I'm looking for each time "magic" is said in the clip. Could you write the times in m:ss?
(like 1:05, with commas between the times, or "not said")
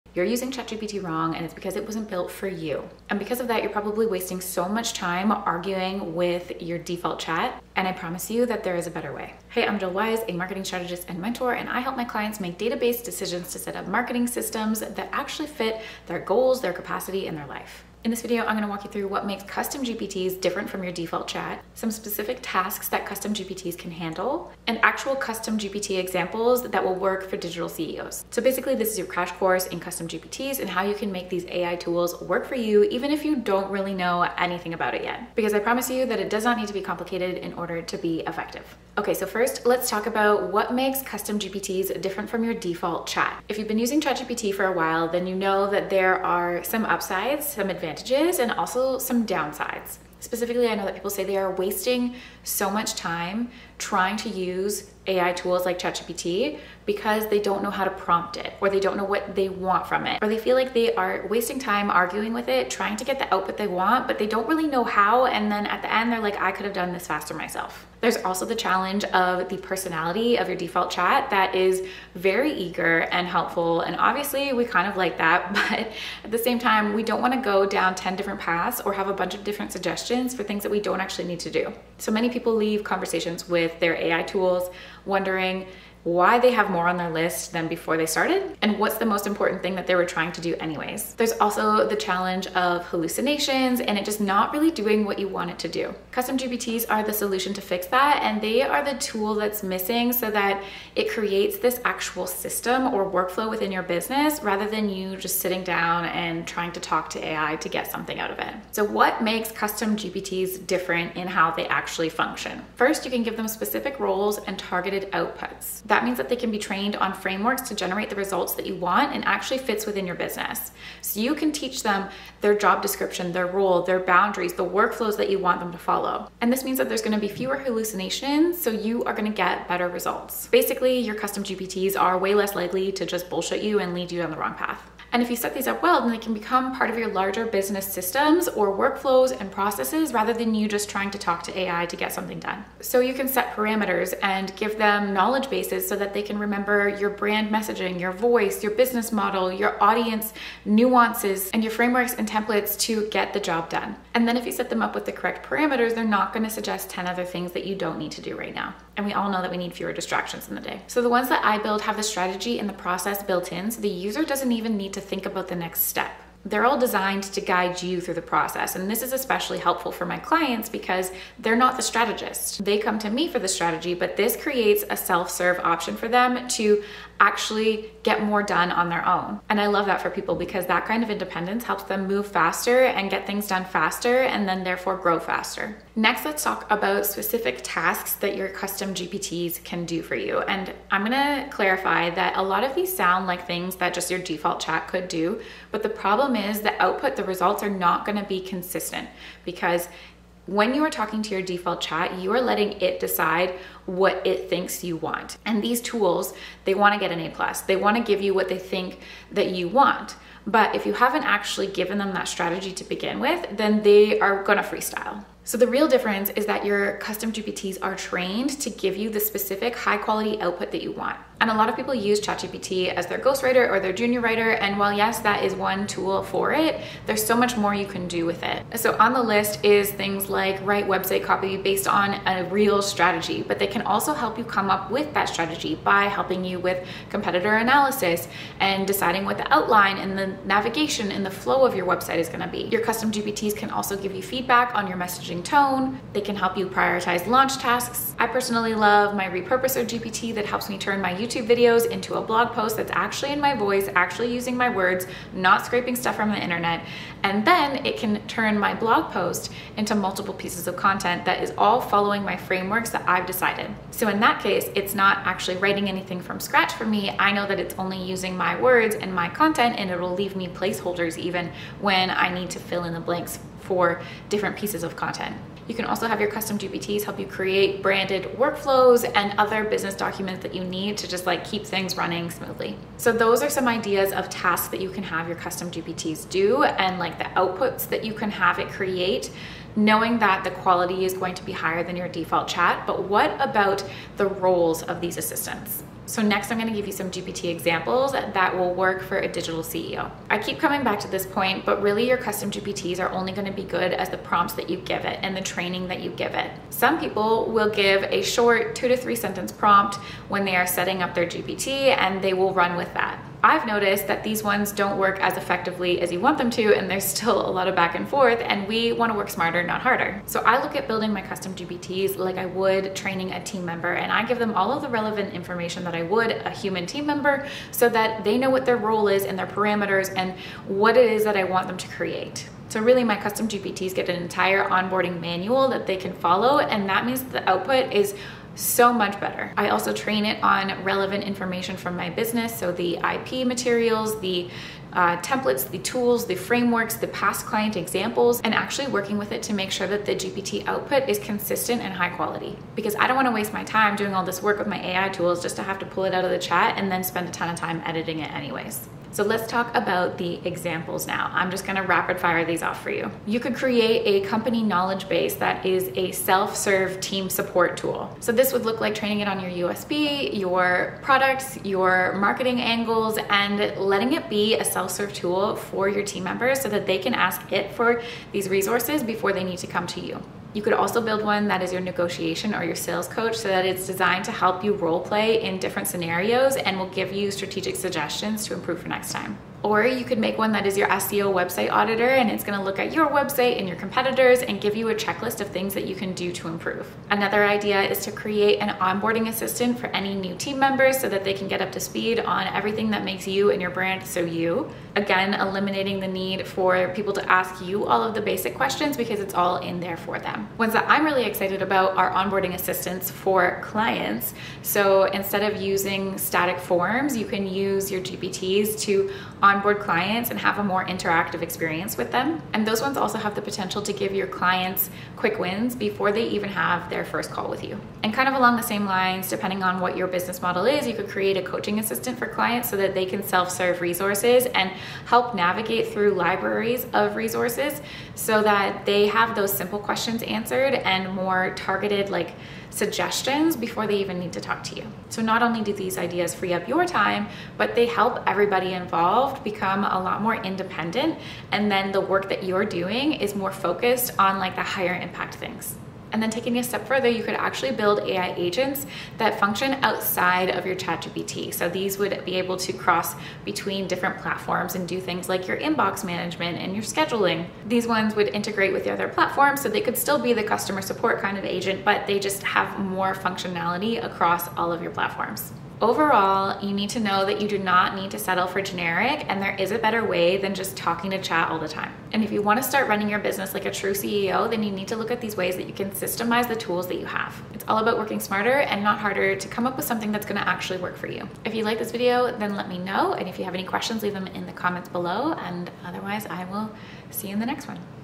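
not said.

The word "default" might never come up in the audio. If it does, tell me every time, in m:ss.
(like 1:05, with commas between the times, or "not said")
0:06, 0:20, 0:42, 1:10, 3:14, 3:21, 4:52.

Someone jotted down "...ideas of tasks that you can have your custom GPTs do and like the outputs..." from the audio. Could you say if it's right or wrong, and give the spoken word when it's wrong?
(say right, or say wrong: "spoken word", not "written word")
right.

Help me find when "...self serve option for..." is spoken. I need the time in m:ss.
2:54.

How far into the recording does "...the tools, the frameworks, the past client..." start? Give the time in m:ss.
5:45.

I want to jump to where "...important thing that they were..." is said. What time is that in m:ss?
1:29.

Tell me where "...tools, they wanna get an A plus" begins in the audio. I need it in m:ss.
3:25.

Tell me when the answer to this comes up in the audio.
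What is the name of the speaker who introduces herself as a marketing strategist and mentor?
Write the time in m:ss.
0:09.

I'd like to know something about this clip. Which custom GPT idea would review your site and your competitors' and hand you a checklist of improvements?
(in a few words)
SEO website auditor.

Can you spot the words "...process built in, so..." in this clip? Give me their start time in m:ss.
2:42.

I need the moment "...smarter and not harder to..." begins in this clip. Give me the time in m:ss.
8:08.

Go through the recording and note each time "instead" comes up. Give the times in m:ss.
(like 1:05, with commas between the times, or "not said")
6:55.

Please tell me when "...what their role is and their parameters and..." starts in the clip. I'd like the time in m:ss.
5:28.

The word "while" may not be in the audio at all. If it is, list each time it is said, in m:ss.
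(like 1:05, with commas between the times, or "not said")
0:44, 3:44.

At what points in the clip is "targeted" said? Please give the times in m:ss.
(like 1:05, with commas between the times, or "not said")
1:54, 7:21.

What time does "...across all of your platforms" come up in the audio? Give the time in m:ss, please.
7:54.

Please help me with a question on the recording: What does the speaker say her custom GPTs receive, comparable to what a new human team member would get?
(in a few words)
an entire onboarding manual.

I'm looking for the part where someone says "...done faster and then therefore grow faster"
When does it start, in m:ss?
3:03.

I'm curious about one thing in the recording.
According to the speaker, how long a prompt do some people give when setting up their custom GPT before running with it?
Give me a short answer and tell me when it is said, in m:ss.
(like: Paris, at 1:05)
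2 to 3 sentences, at 5:08.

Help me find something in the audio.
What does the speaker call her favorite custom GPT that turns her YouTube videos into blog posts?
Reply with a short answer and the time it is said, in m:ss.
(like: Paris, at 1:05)
repurposer GPT, at 4:09.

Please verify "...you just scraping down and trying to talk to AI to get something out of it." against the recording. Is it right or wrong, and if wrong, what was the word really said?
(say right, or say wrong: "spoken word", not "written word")
wrong: "sitting", not "scraping".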